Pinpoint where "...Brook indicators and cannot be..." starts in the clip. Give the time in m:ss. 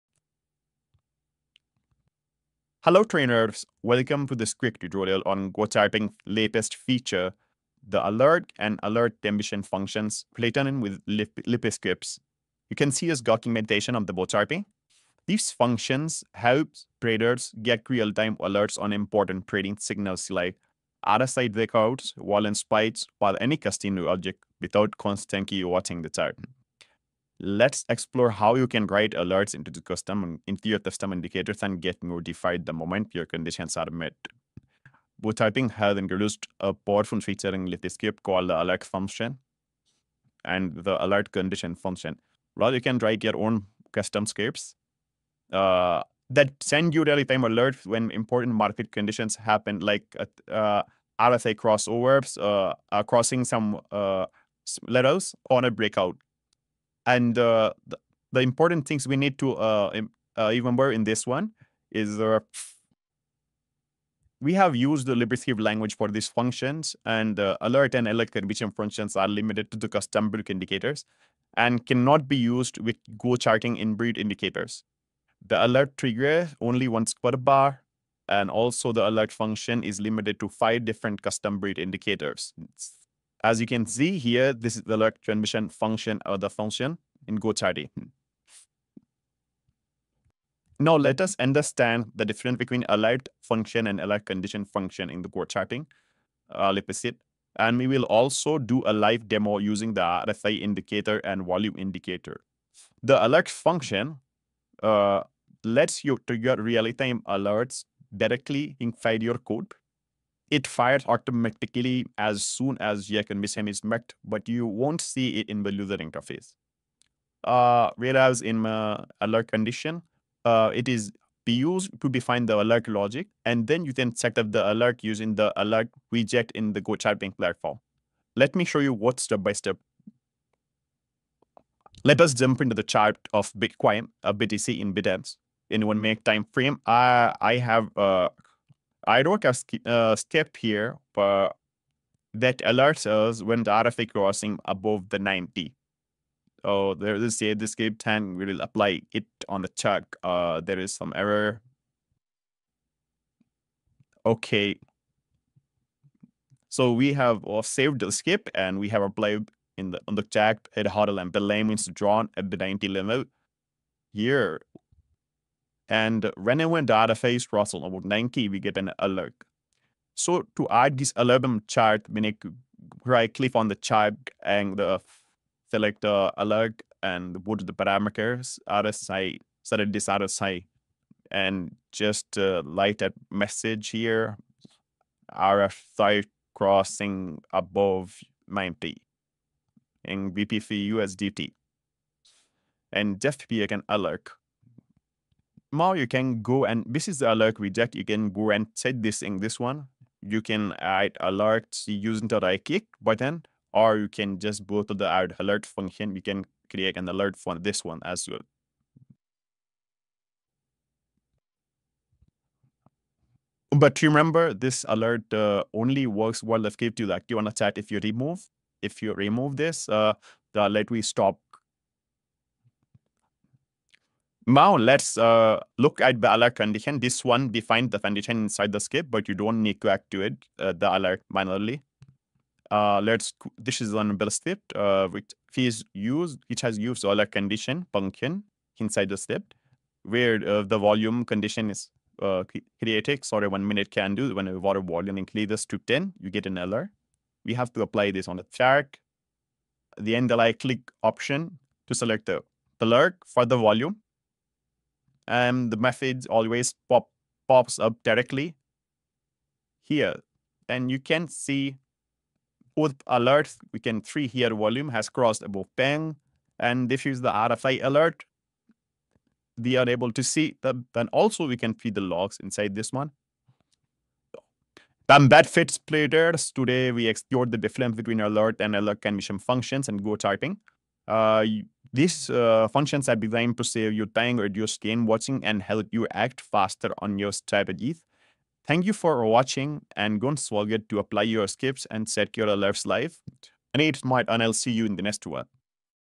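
1:10.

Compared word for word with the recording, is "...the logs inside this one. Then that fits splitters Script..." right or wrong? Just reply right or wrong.
wrong.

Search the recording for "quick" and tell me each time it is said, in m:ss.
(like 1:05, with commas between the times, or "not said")
0:04.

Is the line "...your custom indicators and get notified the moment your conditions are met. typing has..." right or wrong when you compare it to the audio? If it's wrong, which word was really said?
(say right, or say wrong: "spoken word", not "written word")
right.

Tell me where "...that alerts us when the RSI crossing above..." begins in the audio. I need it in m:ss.
2:22.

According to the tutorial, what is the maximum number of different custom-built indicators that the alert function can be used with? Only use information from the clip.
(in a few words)
5.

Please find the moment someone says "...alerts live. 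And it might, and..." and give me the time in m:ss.
4:52.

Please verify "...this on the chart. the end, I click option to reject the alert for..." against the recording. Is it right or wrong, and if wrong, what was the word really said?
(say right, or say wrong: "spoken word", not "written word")
wrong: "select", not "reject".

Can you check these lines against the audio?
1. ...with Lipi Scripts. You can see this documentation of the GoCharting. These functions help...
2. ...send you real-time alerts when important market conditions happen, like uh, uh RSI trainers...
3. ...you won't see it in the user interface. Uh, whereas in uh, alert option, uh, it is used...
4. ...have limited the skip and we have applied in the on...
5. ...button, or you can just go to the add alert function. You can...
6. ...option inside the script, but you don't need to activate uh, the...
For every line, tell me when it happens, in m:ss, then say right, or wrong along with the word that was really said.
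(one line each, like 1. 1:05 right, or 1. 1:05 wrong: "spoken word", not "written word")
1. 0:10 right
2. 0:46 wrong: "crossovers", not "trainers"
3. 1:54 wrong: "condition", not "option"
4. 2:37 wrong: "saved", not "limited"
5. 3:23 right
6. 3:47 wrong: "condition", not "option".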